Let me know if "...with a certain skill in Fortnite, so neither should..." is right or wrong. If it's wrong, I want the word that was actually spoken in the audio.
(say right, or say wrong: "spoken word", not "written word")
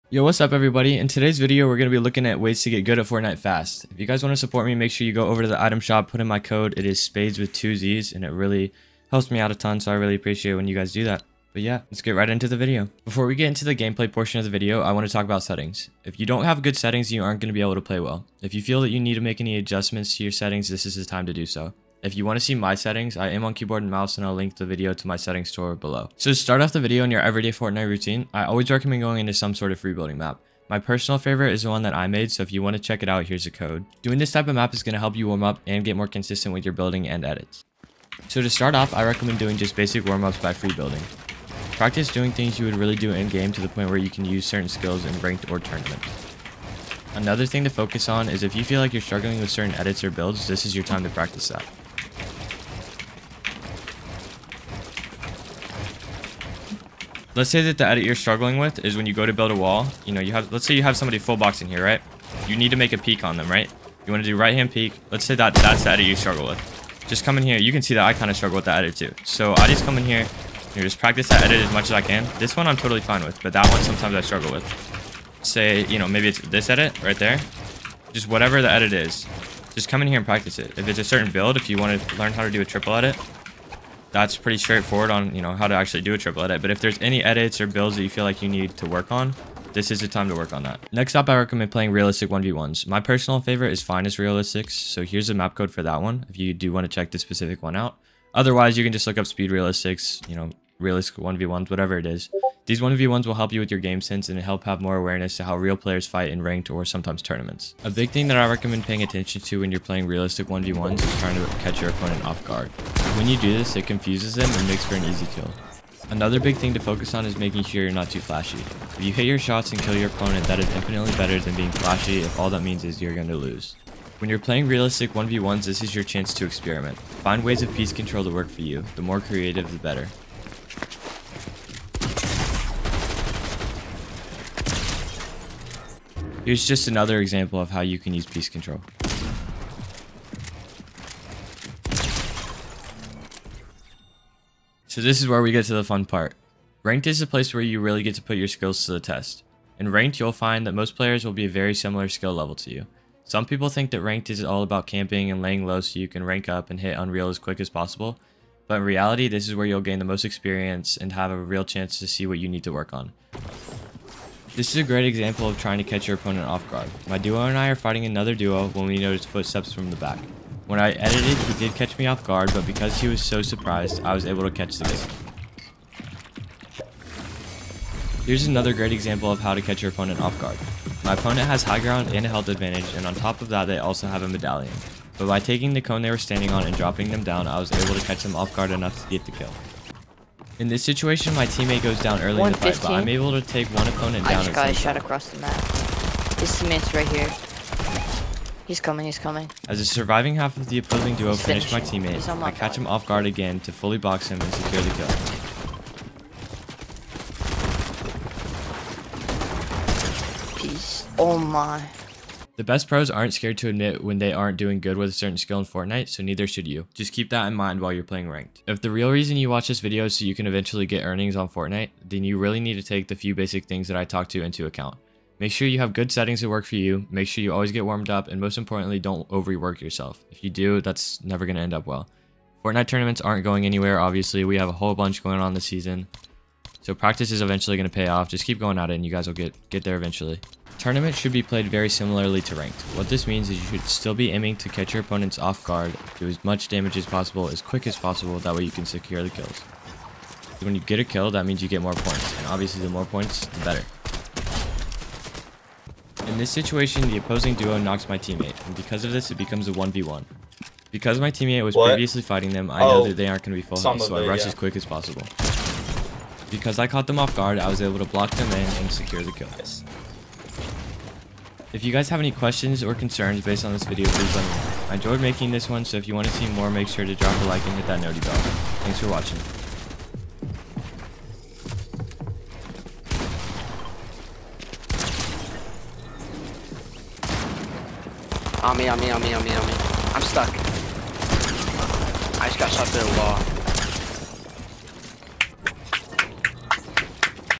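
right.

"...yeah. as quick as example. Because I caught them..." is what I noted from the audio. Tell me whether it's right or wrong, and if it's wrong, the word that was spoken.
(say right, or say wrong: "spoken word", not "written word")
wrong: "possible", not "example".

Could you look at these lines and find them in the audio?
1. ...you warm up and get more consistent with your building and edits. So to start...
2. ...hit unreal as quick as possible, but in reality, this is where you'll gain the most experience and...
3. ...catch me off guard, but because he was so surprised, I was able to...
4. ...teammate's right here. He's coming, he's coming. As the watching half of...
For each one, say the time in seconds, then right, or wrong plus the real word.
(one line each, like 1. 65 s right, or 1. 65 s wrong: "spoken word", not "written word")
1. 35 s right
2. 156 s right
3. 171 s right
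4. 196 s wrong: "surviving", not "watching".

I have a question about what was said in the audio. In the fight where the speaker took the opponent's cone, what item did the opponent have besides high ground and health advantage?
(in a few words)
A medallion.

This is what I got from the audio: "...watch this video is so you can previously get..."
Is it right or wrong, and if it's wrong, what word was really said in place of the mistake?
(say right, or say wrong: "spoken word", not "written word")
wrong: "eventually", not "previously".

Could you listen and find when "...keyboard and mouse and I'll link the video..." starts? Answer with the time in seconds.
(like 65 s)
23 s.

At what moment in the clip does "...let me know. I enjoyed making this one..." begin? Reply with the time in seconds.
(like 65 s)
274 s.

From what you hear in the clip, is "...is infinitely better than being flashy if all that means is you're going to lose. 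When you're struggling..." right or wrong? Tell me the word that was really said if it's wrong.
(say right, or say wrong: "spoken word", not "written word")
wrong: "playing", not "struggling".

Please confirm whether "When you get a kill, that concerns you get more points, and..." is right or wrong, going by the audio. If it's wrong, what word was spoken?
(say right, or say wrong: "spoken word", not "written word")
wrong: "means", not "concerns".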